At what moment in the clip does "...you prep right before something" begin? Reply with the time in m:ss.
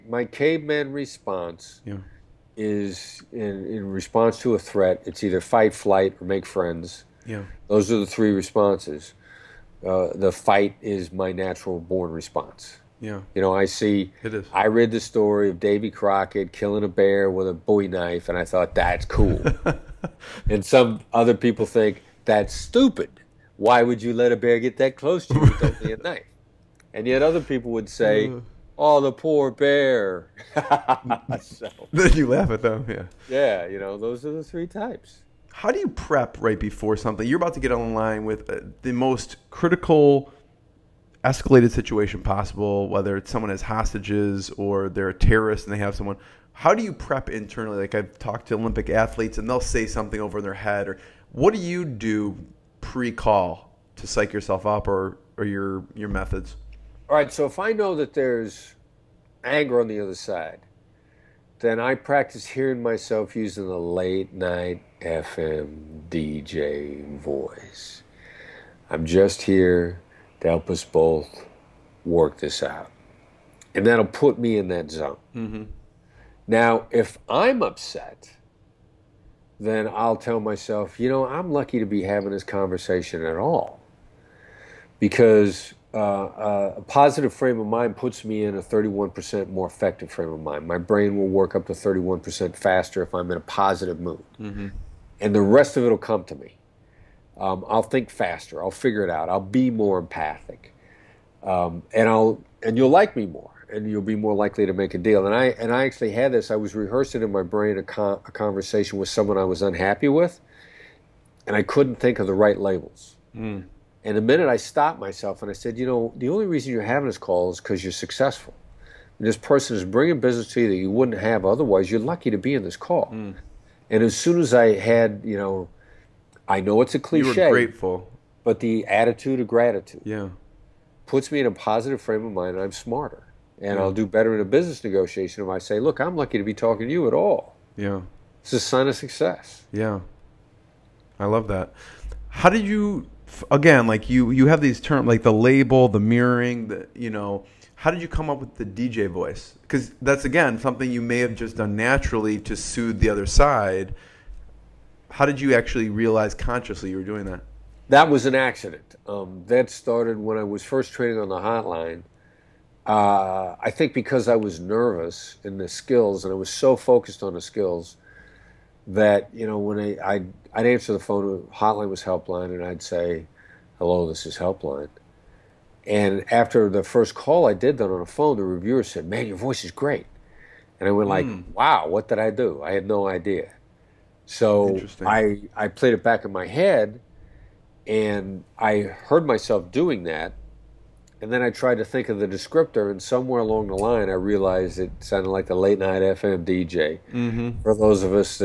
0:35.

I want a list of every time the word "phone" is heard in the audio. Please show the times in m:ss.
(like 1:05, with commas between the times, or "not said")
2:50, 2:58.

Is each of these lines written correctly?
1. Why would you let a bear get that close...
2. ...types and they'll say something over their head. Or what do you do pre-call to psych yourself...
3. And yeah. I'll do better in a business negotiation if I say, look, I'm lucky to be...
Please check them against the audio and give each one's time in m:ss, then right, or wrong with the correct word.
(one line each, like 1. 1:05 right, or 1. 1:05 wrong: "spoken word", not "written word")
1. 0:23 right
2. 0:48 wrong: "athletes", not "types"
3. 2:13 right.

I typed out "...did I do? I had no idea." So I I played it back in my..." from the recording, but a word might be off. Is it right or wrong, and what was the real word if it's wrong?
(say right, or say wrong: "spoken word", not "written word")
right.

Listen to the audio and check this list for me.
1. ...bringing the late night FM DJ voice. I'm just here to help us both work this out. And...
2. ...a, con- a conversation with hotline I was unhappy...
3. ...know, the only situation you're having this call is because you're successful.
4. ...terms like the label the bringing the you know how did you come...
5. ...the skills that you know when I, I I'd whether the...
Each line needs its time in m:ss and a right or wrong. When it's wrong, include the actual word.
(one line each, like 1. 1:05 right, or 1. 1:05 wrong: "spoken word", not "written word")
1. 1:03 wrong: "using", not "bringing"
2. 1:47 wrong: "someone", not "hotline"
3. 1:55 wrong: "reason", not "situation"
4. 2:24 wrong: "mirroring", not "bringing"
5. 2:47 wrong: "answer", not "whether".